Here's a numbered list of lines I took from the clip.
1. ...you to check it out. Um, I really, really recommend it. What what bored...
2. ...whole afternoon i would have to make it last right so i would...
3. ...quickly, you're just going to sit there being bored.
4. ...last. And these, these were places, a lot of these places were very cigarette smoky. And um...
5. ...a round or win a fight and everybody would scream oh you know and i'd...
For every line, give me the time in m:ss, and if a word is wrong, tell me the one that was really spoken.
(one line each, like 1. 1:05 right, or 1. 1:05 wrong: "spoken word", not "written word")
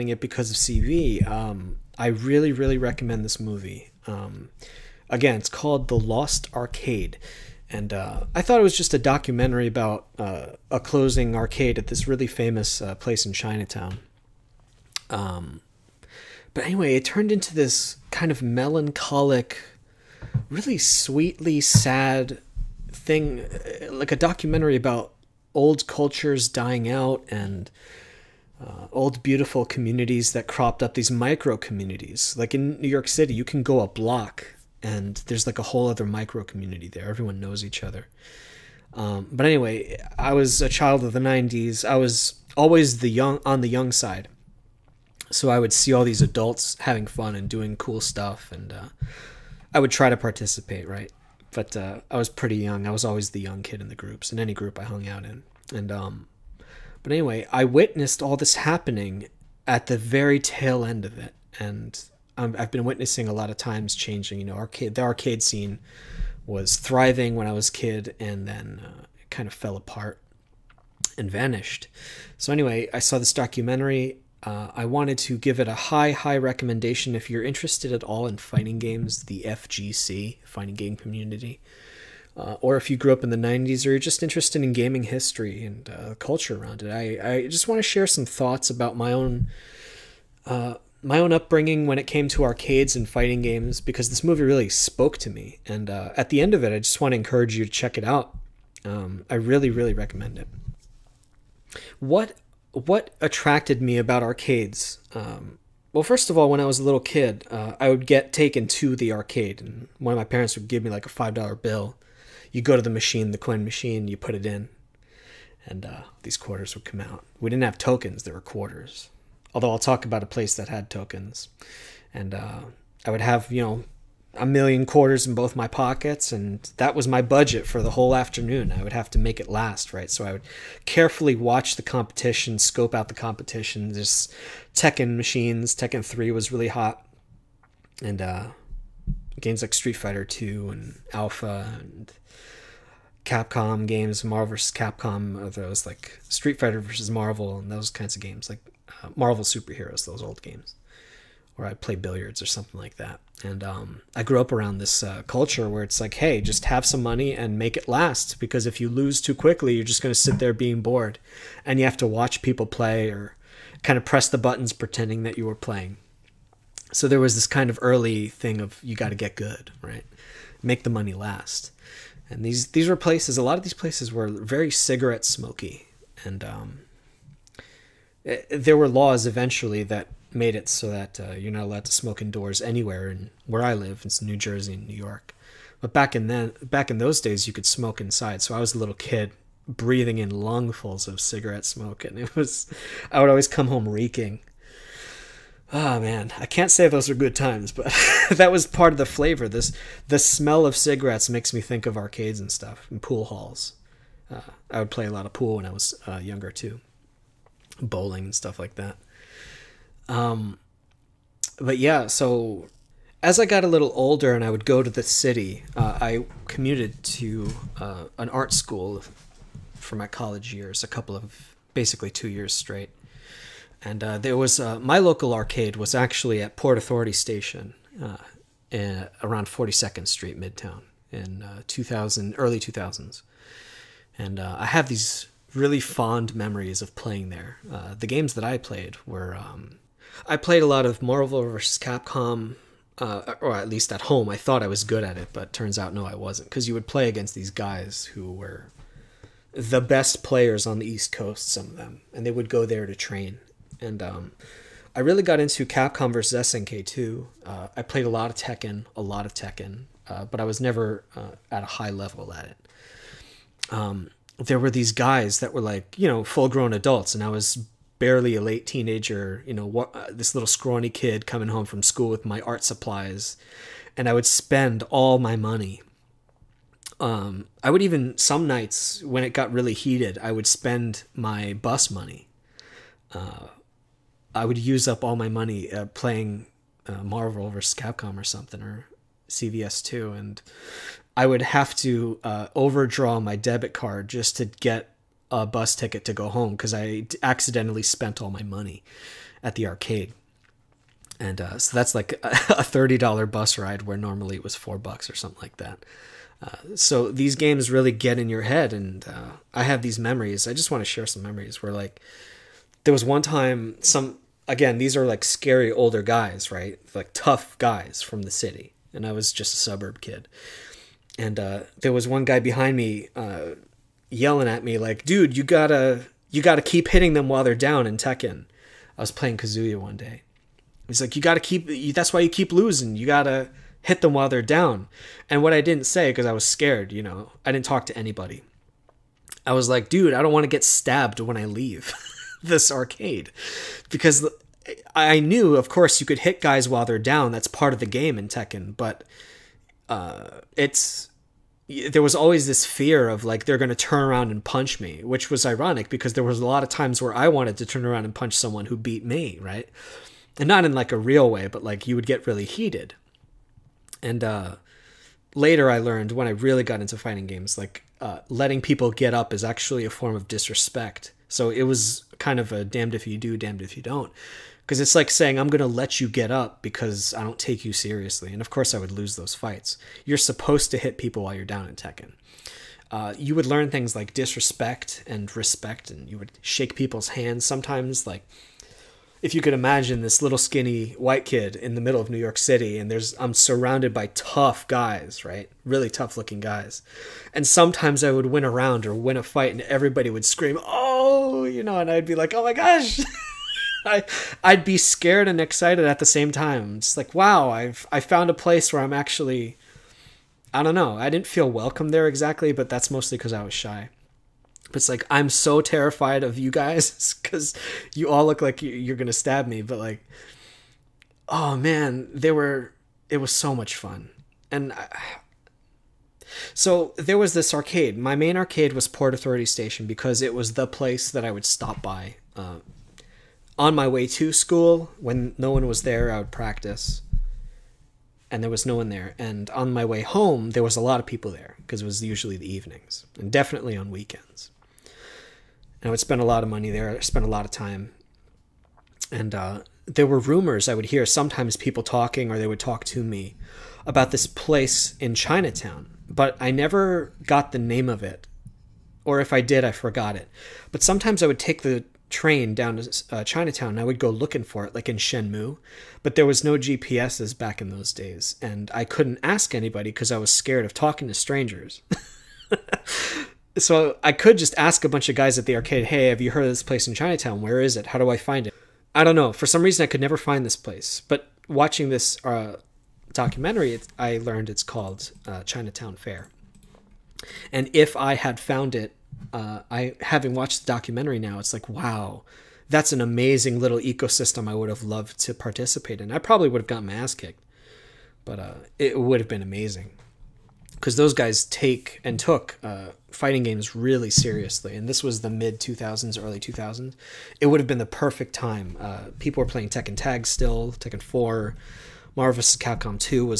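1. 1:37 wrong: "attracted", not "bored"
2. 2:07 right
3. 2:39 right
4. 2:51 right
5. 6:38 right.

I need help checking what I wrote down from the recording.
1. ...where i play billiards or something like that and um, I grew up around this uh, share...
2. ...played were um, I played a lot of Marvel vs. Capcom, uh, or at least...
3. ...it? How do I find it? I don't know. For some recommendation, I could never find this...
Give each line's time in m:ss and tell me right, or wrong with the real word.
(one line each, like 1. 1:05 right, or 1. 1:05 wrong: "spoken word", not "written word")
1. 2:31 wrong: "culture", not "share"
2. 3:58 right
3. 7:57 wrong: "reason", not "recommendation".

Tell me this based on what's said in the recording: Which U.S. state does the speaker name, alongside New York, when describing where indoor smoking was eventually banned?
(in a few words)
New Jersey.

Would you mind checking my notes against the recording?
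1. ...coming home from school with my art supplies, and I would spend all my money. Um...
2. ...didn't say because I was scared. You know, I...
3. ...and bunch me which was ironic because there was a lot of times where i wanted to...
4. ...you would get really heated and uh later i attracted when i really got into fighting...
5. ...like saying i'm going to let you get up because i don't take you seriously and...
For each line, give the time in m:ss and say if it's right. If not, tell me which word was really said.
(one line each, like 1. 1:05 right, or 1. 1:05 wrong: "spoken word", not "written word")
1. 4:31 right
2. 5:35 right
3. 5:54 wrong: "punch", not "bunch"
4. 6:01 wrong: "learned", not "attracted"
5. 6:14 right.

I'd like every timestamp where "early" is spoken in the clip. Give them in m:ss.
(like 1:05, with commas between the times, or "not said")
2:47, 3:52, 8:26.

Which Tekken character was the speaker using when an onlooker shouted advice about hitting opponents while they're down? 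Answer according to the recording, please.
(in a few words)
Kazuya.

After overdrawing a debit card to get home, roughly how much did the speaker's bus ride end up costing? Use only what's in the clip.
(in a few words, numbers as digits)
$30.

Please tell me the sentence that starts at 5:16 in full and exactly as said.
Like tough guys from the city.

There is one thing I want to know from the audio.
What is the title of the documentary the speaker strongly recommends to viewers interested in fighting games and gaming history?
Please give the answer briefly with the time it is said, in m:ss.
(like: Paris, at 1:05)
The Lost Arcade, at 0:05.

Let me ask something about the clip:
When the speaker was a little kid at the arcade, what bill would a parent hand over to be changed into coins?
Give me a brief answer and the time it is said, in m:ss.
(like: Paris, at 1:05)
Five dollar bill, at 1:51.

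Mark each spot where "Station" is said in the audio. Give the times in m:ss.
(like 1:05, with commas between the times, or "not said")
3:47, 7:09.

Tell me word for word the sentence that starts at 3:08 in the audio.
So I was a little kid breathing in lungfuls of cigarette smoke, and it was I would always come home reeking.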